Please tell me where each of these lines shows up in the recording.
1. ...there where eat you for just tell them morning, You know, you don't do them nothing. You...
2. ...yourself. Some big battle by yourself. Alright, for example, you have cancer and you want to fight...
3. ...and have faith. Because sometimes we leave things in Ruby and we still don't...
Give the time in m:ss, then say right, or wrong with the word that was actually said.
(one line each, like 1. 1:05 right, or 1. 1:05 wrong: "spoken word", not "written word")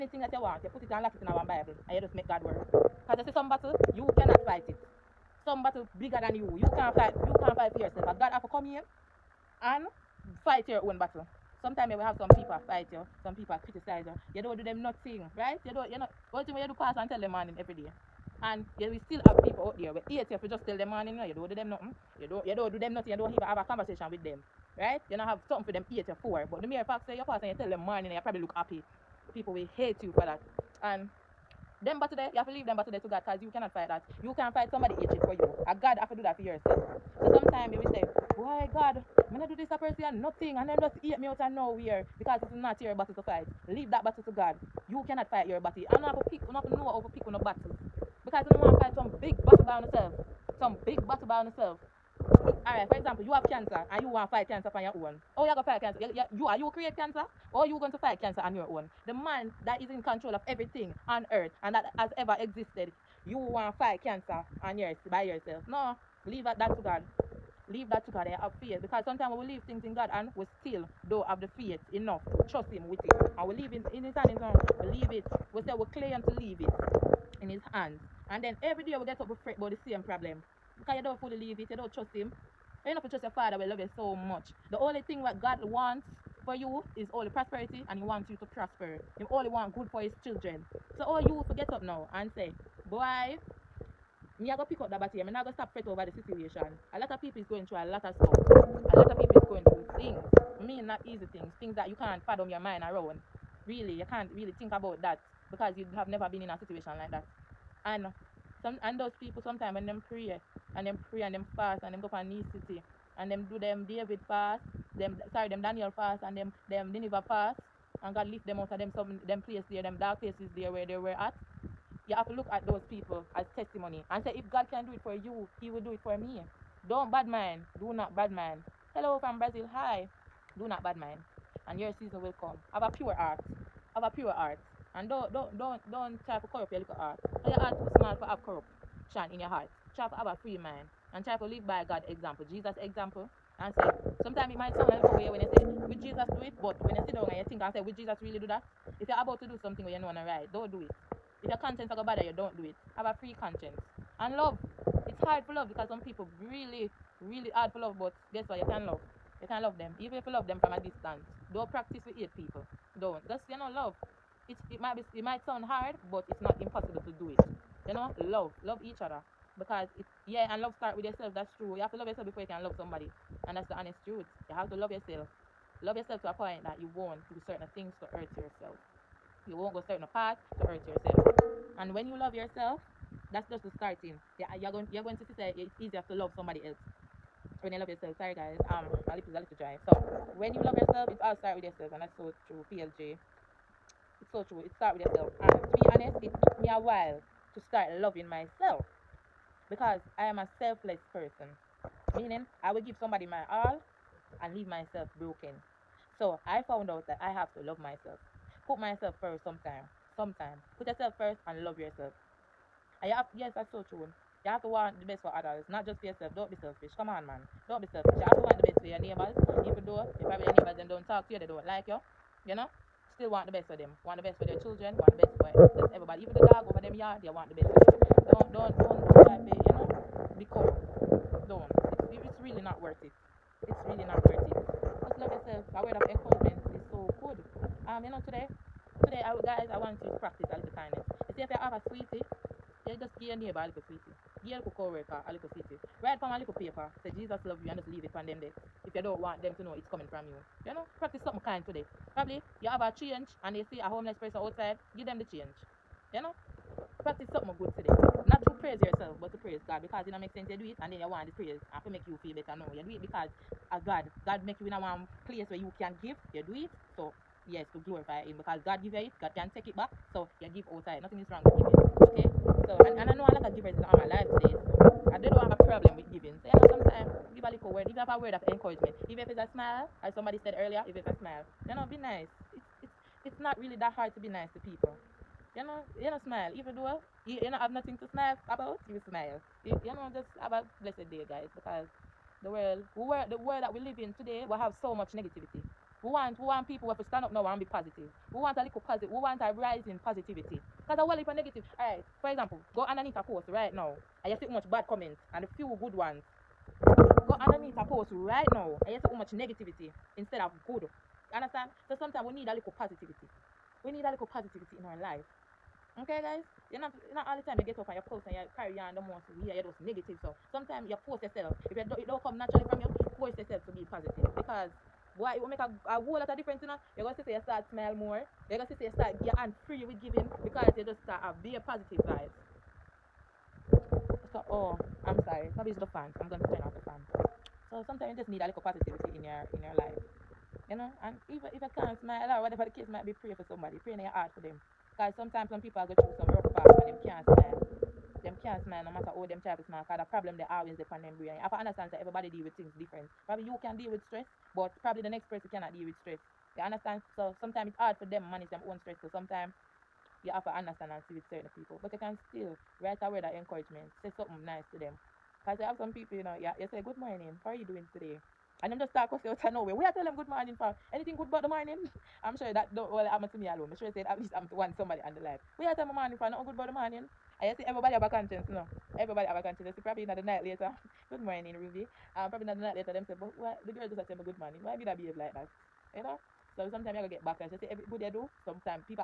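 1. 0:19 right
2. 0:49 right
3. 1:08 wrong: "God", not "Ruby".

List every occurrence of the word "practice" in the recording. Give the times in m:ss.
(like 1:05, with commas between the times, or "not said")
2:41, 4:00, 4:11, 4:17.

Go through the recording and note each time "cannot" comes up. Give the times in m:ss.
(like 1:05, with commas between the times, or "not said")
0:04, 0:33, 0:45, 5:55.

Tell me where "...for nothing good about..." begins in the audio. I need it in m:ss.
6:16.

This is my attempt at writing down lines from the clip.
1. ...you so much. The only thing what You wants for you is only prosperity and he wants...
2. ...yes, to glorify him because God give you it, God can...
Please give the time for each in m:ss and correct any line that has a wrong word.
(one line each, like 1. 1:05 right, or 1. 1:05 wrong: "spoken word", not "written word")
1. 1:23 wrong: "God", not "You"
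2. 4:27 right.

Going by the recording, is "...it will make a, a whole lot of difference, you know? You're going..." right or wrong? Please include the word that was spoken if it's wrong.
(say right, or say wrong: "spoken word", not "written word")
right.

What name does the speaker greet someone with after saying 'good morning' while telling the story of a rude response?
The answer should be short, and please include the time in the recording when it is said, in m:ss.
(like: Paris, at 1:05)
Ruby, at 6:21.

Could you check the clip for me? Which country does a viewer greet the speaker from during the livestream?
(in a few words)
Brazil.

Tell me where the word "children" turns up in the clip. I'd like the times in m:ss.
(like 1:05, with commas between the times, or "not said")
1:30, 3:44.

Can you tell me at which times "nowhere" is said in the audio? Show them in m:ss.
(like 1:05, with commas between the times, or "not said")
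0:41, 6:09.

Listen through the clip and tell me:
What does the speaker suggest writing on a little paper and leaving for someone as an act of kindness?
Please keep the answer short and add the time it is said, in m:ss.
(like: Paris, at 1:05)
Jesus love you, at 4:07.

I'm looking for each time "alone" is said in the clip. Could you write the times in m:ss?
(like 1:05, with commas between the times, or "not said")
6:13.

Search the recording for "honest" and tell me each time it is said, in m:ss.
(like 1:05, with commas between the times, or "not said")
2:53, 3:15.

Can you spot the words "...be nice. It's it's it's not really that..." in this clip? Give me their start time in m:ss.
4:41.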